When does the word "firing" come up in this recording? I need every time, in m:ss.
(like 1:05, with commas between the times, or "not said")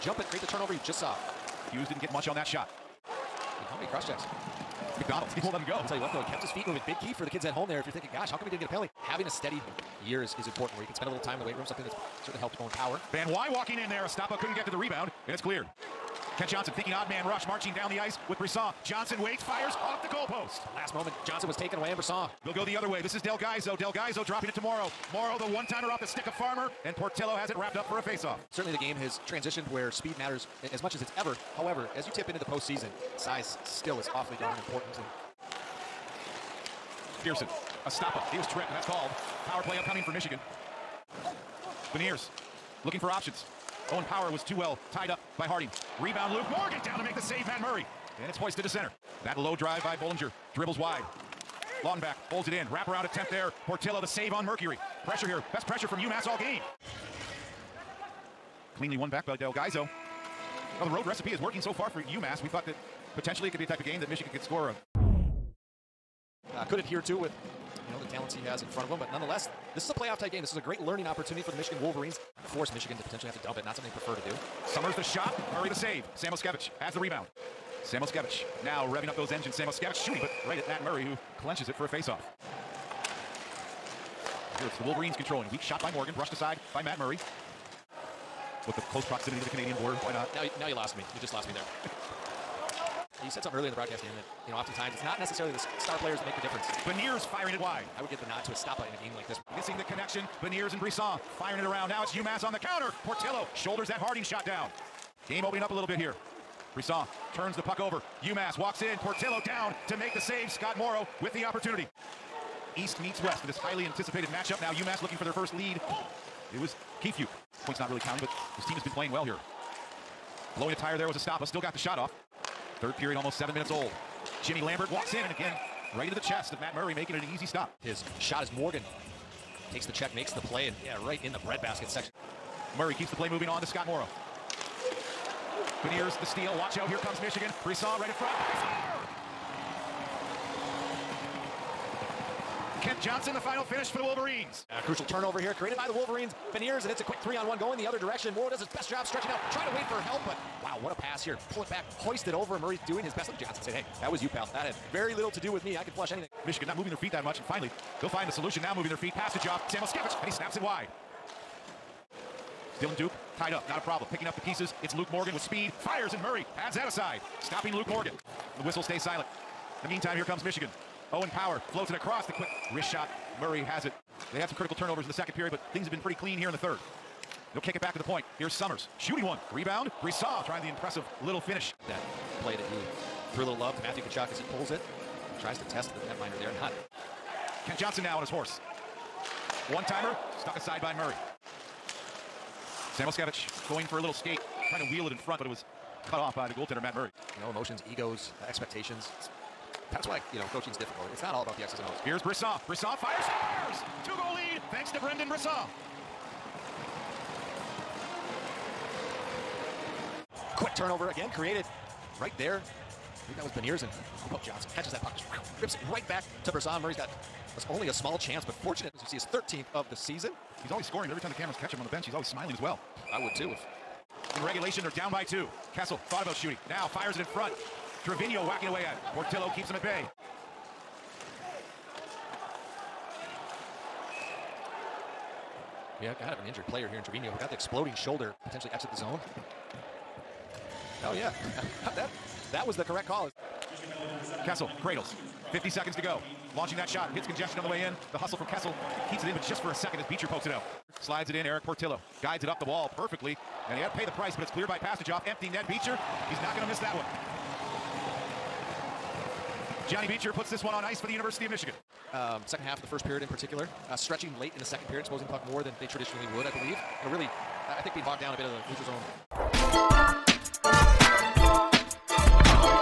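1:37, 1:41.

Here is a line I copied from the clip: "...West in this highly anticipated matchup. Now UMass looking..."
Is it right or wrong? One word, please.
right.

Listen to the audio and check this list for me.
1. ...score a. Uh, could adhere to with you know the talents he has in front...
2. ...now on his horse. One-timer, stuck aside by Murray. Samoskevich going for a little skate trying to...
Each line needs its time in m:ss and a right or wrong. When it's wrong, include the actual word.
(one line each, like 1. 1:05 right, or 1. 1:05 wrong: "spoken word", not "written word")
1. 1:04 right
2. 3:08 right.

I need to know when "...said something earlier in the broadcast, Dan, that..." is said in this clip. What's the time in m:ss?
1:33.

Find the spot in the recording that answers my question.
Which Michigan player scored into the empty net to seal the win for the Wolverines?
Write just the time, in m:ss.
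4:19.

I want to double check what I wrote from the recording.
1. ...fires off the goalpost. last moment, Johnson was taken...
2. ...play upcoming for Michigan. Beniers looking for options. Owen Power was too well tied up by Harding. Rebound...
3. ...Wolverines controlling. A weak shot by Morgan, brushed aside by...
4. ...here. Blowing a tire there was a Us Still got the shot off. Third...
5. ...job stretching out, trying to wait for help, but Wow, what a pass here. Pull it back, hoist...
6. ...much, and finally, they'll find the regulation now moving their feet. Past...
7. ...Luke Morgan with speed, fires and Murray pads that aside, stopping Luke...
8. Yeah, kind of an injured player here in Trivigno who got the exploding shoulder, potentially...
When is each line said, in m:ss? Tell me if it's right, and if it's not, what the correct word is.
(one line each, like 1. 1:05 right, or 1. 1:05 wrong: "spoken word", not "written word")
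1. 0:19 right
2. 0:39 right
3. 1:24 right
4. 1:59 right
5. 2:28 right
6. 2:37 wrong: "solution", not "regulation"
7. 2:44 right
8. 3:56 right.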